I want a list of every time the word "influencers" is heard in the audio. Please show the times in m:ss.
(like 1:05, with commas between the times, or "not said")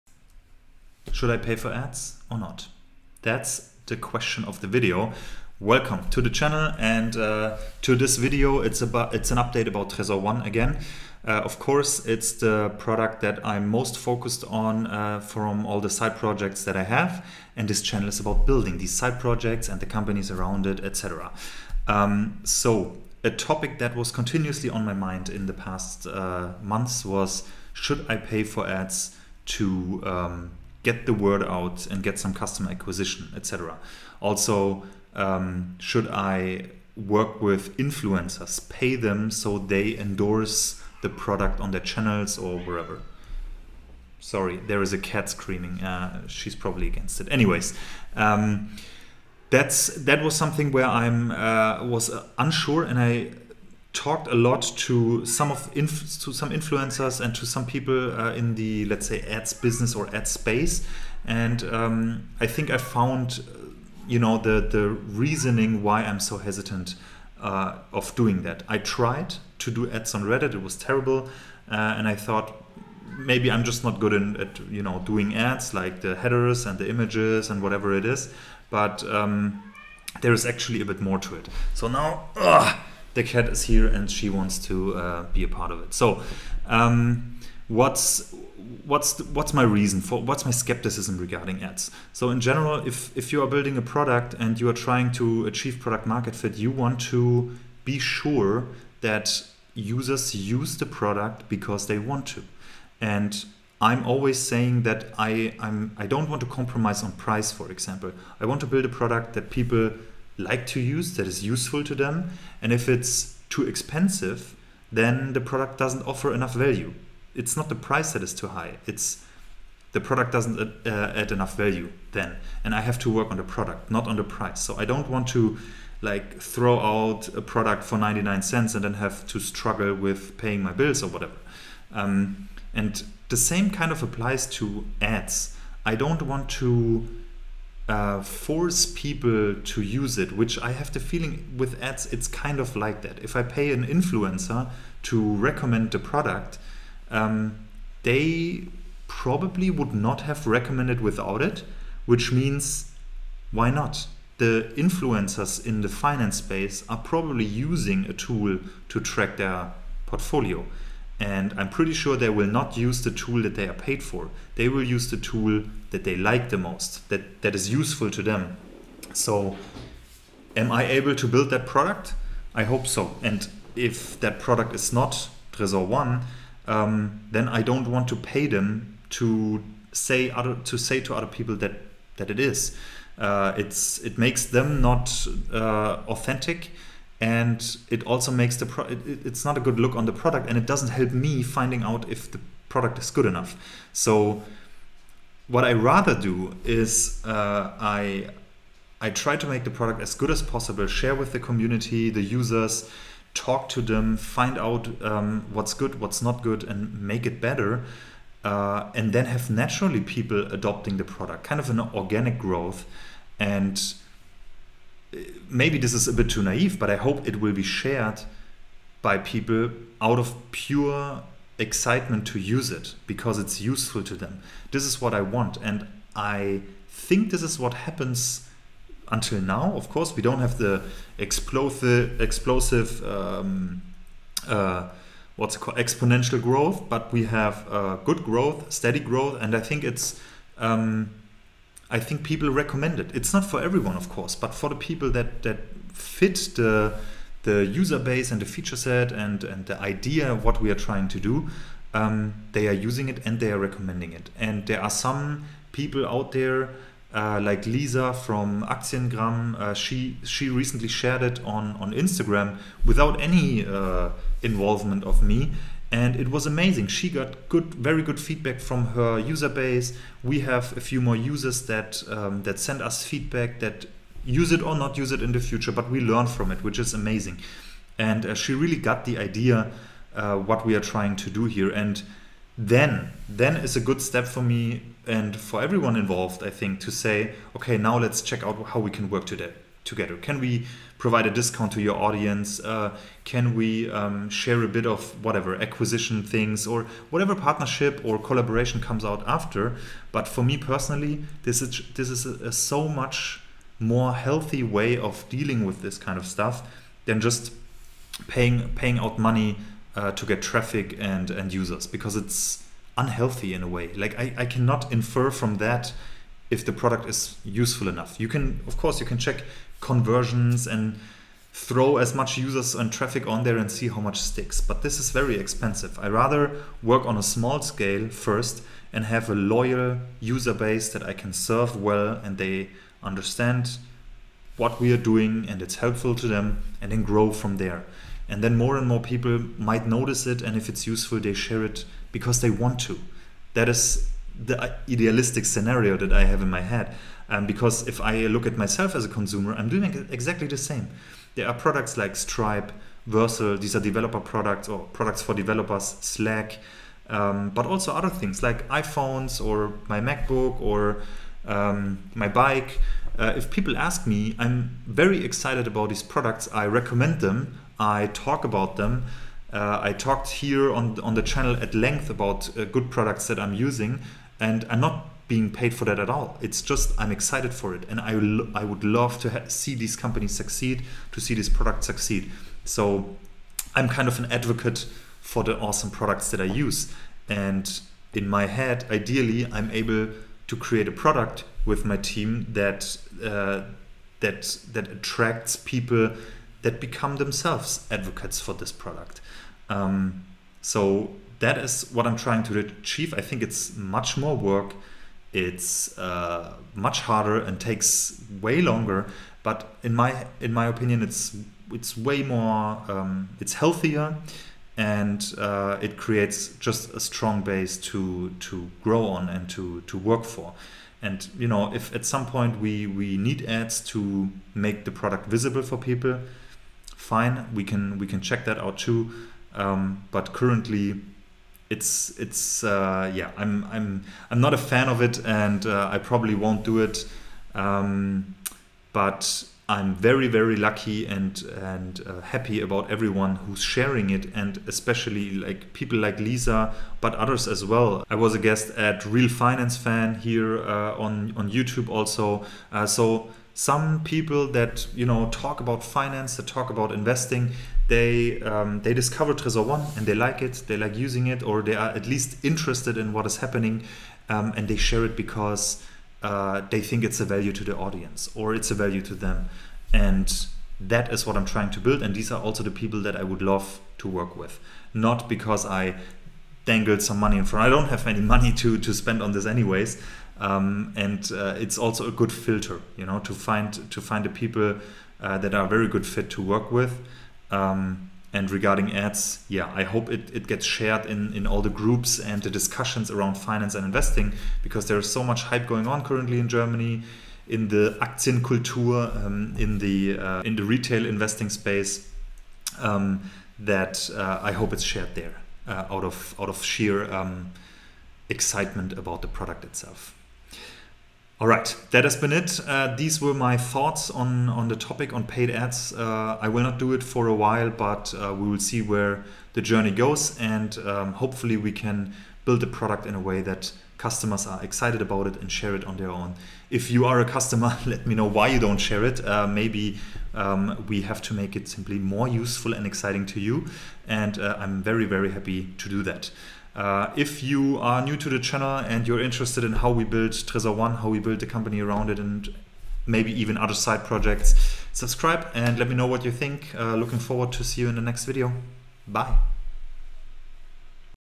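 0:37, 0:56, 2:23, 2:34.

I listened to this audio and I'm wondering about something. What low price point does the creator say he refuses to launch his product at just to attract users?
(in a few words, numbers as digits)
99 cents.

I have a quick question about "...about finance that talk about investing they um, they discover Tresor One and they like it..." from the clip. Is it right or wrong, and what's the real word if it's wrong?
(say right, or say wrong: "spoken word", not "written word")
right.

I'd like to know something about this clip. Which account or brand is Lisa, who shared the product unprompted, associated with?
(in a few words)
Aktiengram.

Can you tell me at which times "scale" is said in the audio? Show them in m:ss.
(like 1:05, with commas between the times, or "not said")
5:27.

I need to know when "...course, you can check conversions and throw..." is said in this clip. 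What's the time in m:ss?
5:18.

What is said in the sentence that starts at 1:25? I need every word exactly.
So, um, what's what's the, what's my reason for what's my skepticism regarding ads?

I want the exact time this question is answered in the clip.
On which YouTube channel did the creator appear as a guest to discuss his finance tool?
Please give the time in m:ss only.
7:29.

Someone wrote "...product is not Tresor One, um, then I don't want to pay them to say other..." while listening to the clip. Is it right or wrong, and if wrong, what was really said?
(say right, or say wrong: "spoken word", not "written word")
right.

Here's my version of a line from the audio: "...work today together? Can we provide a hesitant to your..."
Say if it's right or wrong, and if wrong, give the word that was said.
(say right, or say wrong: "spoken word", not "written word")
wrong: "discount", not "hesitant".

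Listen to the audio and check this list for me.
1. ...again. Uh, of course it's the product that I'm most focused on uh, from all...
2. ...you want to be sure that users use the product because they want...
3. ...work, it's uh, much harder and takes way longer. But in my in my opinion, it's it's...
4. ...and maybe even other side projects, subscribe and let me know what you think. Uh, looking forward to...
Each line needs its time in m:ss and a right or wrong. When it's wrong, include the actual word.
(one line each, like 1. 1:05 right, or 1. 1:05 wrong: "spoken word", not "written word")
1. 0:10 right
2. 1:36 right
3. 6:44 right
4. 9:02 right.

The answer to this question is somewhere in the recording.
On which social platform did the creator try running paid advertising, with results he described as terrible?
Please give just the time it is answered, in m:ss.
1:10.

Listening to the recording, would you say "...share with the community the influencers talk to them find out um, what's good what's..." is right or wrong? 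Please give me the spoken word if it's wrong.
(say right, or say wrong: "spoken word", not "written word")
wrong: "users", not "influencers".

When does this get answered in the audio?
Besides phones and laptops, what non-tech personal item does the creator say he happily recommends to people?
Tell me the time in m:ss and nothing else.
6:02.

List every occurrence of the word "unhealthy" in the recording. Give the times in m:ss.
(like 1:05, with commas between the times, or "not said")
5:12.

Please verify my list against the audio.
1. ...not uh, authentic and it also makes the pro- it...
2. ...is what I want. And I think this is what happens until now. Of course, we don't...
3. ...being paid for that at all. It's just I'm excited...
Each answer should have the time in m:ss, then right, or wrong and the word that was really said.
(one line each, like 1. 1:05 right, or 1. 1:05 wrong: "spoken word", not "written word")
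1. 3:04 right
2. 3:44 right
3. 6:15 right.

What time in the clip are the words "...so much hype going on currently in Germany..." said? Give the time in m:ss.
8:15.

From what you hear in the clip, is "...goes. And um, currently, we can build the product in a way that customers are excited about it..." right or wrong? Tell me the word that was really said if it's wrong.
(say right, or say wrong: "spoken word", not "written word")
wrong: "hopefully", not "currently".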